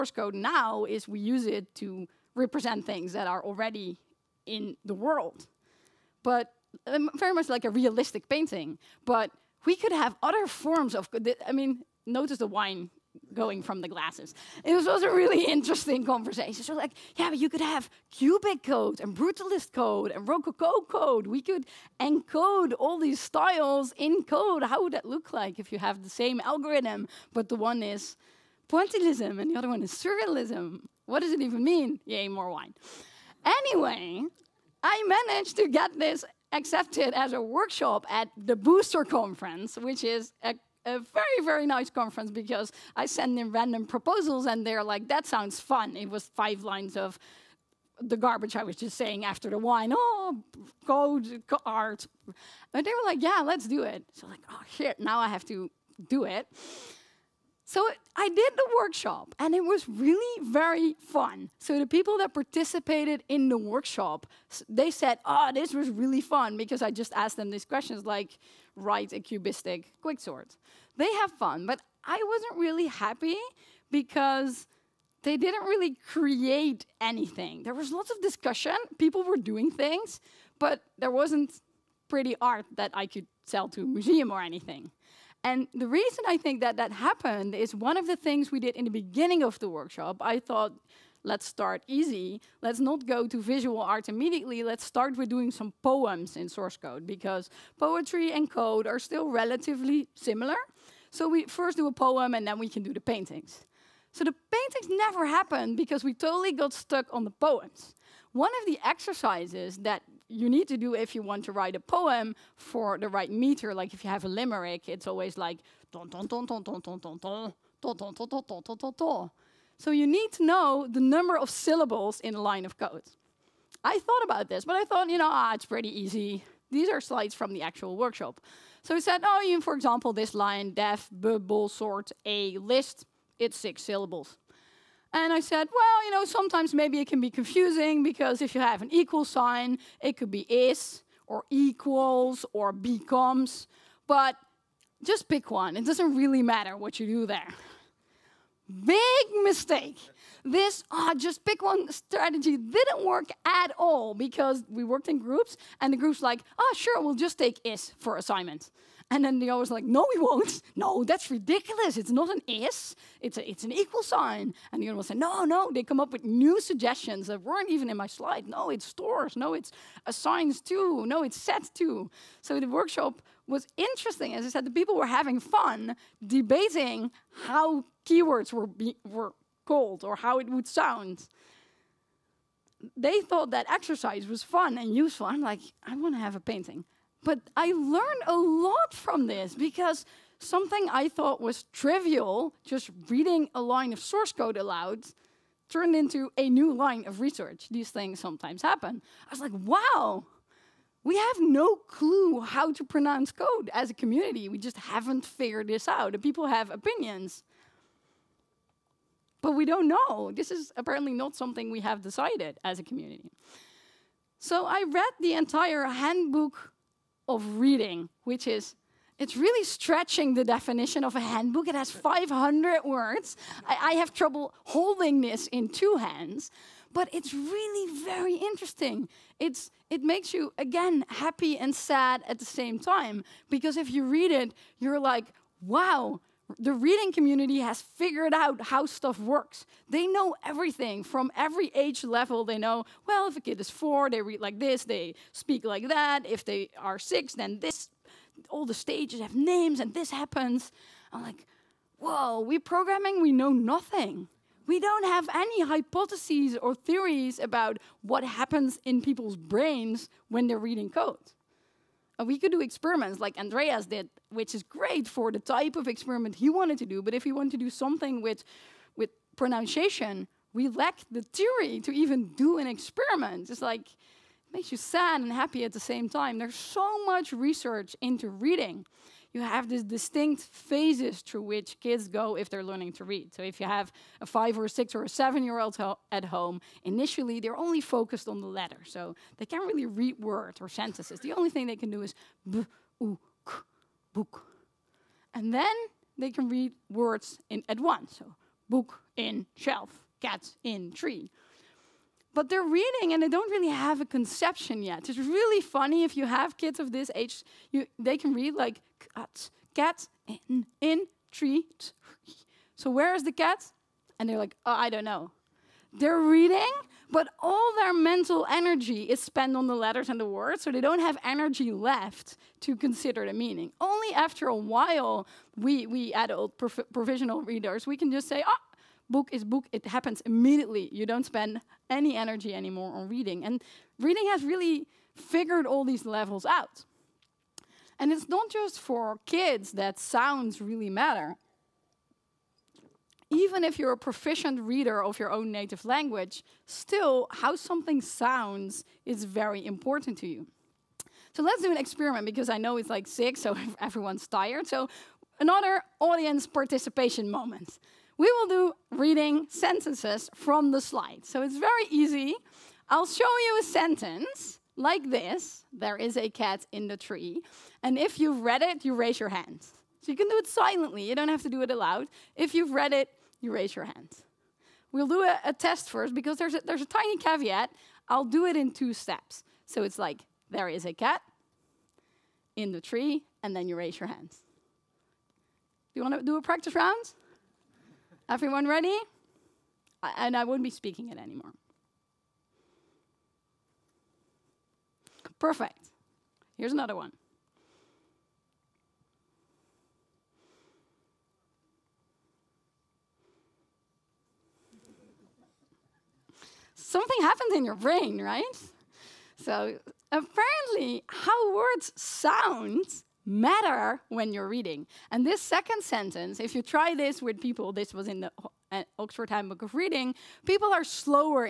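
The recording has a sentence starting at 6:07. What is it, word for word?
And if you've read it, you raise your hand.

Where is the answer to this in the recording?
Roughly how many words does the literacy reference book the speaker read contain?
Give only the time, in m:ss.
3:41.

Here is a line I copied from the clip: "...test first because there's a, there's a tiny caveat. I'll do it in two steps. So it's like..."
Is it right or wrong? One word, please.
right.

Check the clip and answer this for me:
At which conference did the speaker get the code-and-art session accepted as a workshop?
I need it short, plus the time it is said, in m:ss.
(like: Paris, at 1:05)
Booster Conference, at 0:38.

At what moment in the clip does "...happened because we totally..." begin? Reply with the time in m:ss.
1:45.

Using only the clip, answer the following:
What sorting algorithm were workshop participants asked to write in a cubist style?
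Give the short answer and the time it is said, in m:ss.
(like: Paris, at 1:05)
Quicksort, at 1:10.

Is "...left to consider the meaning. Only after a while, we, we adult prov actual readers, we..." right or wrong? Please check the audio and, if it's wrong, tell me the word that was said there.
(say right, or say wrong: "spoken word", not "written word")
wrong: "provisional", not "actual".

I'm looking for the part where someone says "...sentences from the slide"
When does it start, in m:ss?
5:59.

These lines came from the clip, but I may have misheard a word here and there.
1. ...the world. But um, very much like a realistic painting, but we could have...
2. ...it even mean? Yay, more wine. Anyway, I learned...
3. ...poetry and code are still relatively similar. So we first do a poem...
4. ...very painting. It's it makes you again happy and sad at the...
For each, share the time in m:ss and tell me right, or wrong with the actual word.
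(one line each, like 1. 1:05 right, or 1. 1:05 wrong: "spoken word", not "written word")
1. 0:04 right
2. 0:31 wrong: "managed", not "learned"
3. 1:37 right
4. 3:48 wrong: "interesting", not "painting".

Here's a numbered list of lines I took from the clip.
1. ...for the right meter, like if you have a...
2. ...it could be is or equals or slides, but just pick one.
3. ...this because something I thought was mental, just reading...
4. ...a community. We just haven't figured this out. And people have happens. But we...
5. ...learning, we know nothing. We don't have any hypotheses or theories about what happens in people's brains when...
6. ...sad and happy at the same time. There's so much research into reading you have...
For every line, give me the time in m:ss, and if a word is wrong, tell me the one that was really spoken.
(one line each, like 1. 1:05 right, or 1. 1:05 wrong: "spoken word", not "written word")
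1. 1:52 right
2. 2:19 wrong: "becomes", not "slides"
3. 3:09 wrong: "trivial", not "mental"
4. 3:23 wrong: "opinions", not "happens"
5. 4:12 wrong: "programming", not "learning"
6. 4:34 right.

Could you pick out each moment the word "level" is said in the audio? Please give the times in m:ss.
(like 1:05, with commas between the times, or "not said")
4:02, 5:36.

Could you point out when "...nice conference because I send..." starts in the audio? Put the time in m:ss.
0:41.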